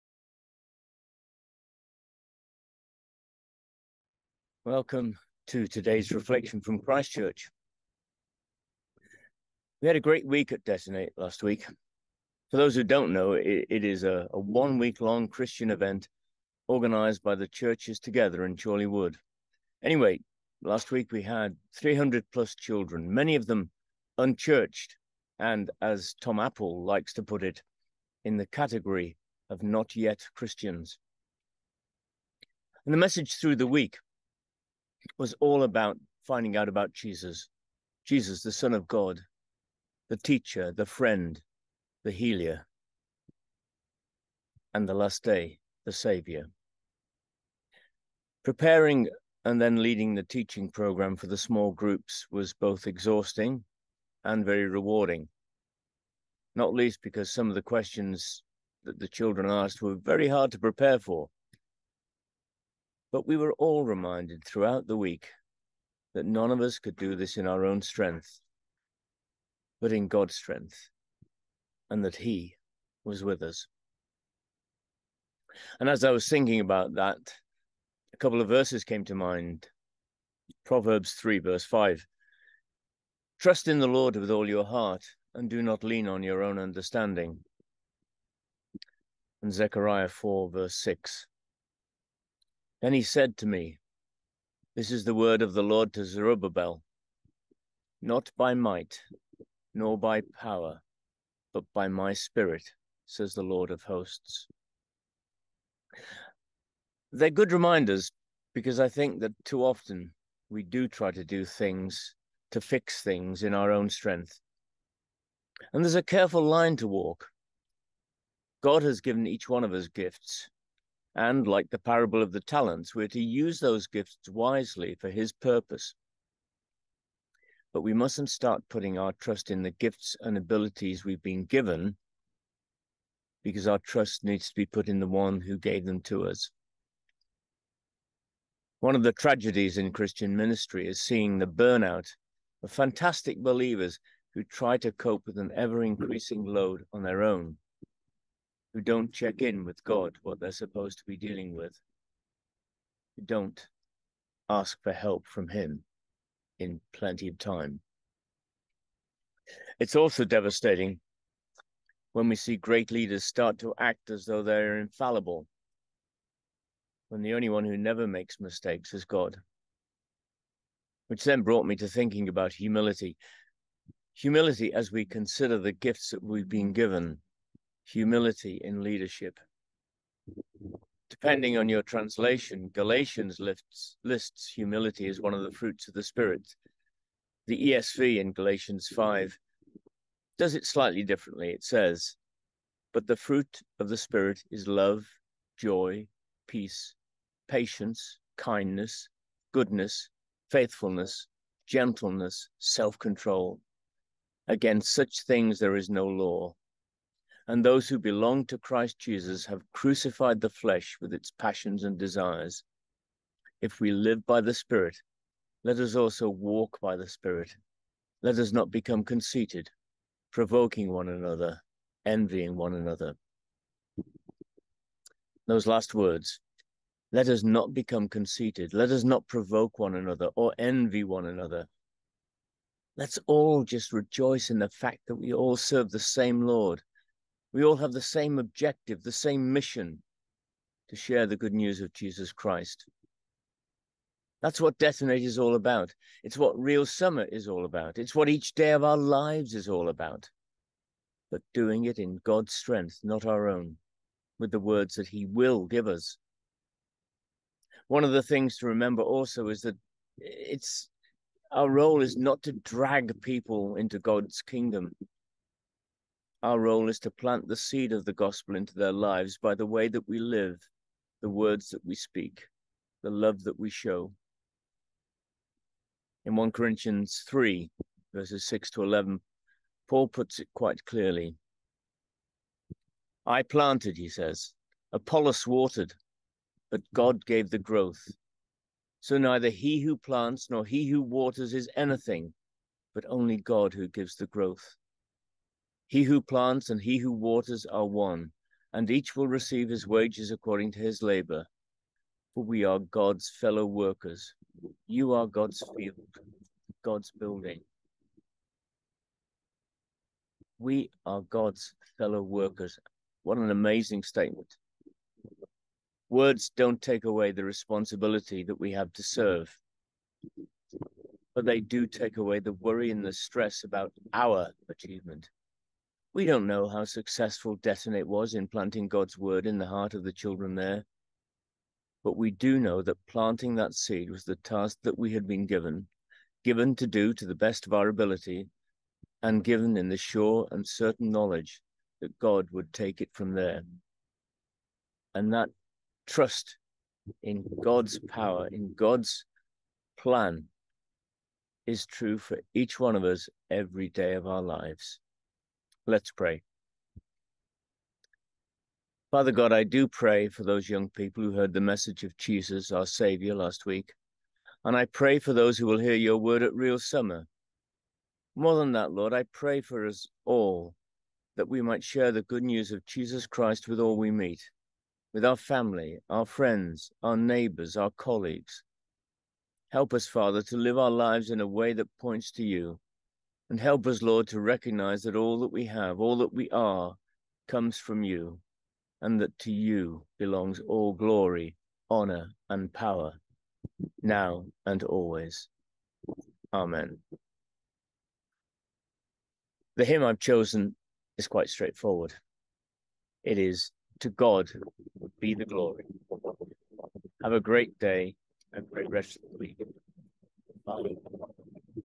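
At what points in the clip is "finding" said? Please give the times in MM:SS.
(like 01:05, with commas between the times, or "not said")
00:36.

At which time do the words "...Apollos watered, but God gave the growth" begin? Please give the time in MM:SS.
04:44.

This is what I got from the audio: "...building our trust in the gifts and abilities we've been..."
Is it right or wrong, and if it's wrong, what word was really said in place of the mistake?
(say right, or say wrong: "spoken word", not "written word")
wrong: "putting", not "building".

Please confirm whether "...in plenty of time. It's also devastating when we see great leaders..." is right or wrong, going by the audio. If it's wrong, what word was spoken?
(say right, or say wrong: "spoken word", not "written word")
right.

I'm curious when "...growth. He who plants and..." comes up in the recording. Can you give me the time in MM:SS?
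04:54.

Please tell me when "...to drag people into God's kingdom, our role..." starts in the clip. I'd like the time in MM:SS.
04:22.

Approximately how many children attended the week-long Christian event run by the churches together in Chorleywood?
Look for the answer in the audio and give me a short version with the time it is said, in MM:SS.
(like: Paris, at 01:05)
300 plus, at 00:21.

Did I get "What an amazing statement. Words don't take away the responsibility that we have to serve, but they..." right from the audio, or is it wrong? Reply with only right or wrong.
right.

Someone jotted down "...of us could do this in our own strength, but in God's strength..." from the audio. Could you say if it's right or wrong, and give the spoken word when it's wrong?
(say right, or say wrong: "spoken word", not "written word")
right.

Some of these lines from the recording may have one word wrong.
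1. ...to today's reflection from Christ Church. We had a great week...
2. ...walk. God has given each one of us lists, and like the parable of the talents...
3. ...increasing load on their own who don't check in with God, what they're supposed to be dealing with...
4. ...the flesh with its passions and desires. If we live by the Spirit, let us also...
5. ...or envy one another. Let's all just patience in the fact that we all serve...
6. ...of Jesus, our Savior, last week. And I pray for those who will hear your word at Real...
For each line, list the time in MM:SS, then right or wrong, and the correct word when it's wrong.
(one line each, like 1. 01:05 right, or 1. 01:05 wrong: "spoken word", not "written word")
1. 00:05 right
2. 01:56 wrong: "gifts", not "lists"
3. 02:25 right
4. 03:30 right
5. 03:50 wrong: "rejoice", not "patience"
6. 06:02 right.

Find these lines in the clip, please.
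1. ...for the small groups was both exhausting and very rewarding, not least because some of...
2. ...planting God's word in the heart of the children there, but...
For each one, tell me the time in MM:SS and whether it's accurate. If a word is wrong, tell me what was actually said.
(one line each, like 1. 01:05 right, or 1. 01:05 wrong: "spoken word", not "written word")
1. 00:51 right
2. 05:28 right.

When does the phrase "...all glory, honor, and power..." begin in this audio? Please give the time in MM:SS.
06:30.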